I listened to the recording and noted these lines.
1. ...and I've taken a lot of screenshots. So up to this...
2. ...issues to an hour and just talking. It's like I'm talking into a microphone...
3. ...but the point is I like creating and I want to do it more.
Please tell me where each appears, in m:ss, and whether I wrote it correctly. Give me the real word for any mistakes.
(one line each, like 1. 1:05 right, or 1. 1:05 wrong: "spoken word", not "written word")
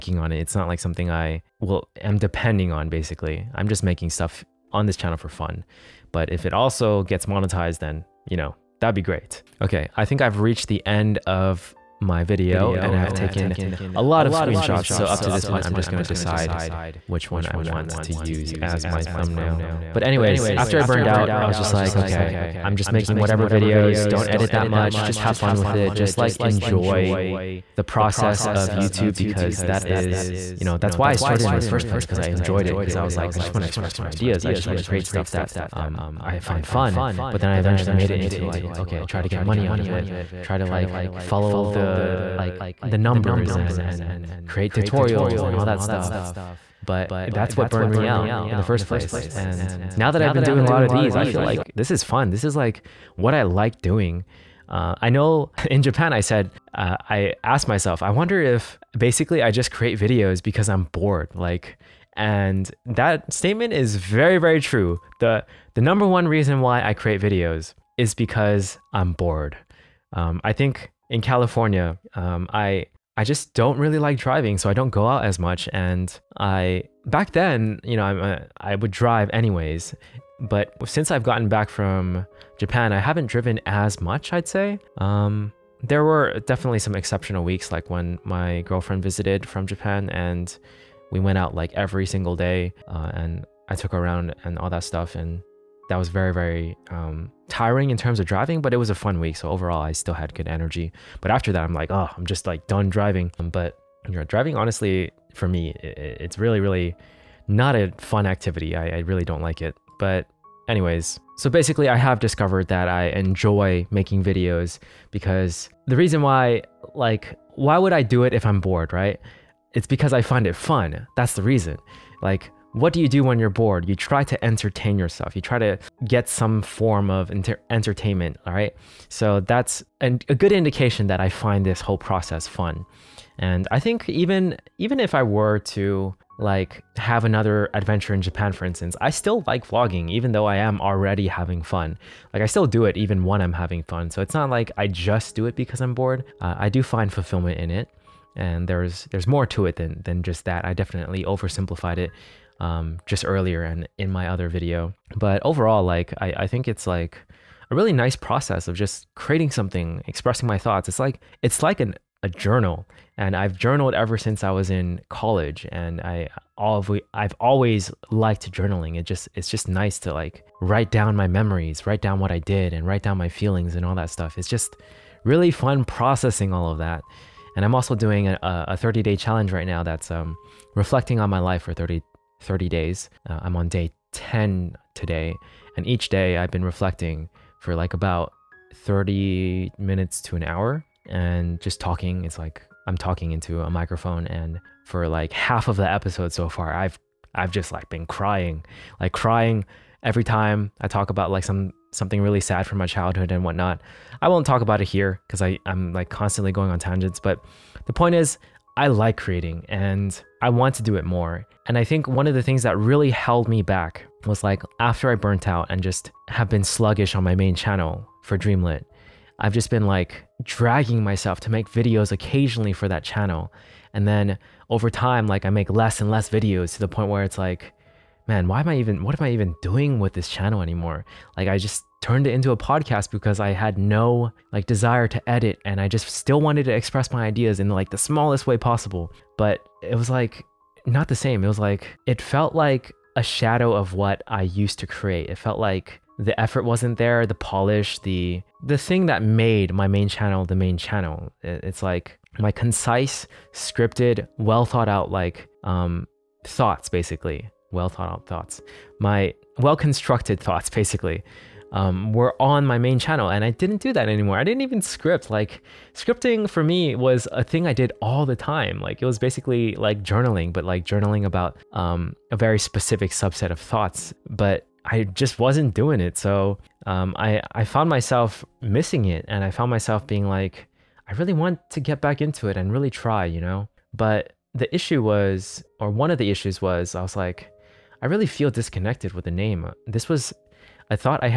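1. 0:12 right
2. 3:09 wrong: "minutes", not "issues"
3. 3:27 right.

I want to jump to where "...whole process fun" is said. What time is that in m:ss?
2:11.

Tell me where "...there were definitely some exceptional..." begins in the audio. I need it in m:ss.
1:25.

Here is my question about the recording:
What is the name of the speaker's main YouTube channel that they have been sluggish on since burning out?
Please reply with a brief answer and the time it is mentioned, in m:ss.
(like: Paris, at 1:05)
Dreamlet, at 3:38.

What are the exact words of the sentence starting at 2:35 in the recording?
But overall, like I, I think it's like a really nice process of just creating something, expressing my thoughts.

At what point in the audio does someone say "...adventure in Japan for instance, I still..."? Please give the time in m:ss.
2:17.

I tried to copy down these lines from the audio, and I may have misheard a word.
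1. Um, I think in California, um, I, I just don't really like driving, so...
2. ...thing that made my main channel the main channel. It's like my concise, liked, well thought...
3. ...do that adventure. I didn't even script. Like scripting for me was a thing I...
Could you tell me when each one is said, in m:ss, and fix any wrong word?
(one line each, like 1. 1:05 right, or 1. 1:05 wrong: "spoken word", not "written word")
1. 1:10 right
2. 4:08 wrong: "scripted", not "liked"
3. 4:23 wrong: "anymore", not "adventure".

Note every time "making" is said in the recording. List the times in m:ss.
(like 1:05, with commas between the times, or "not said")
0:03, 0:22, 1:53.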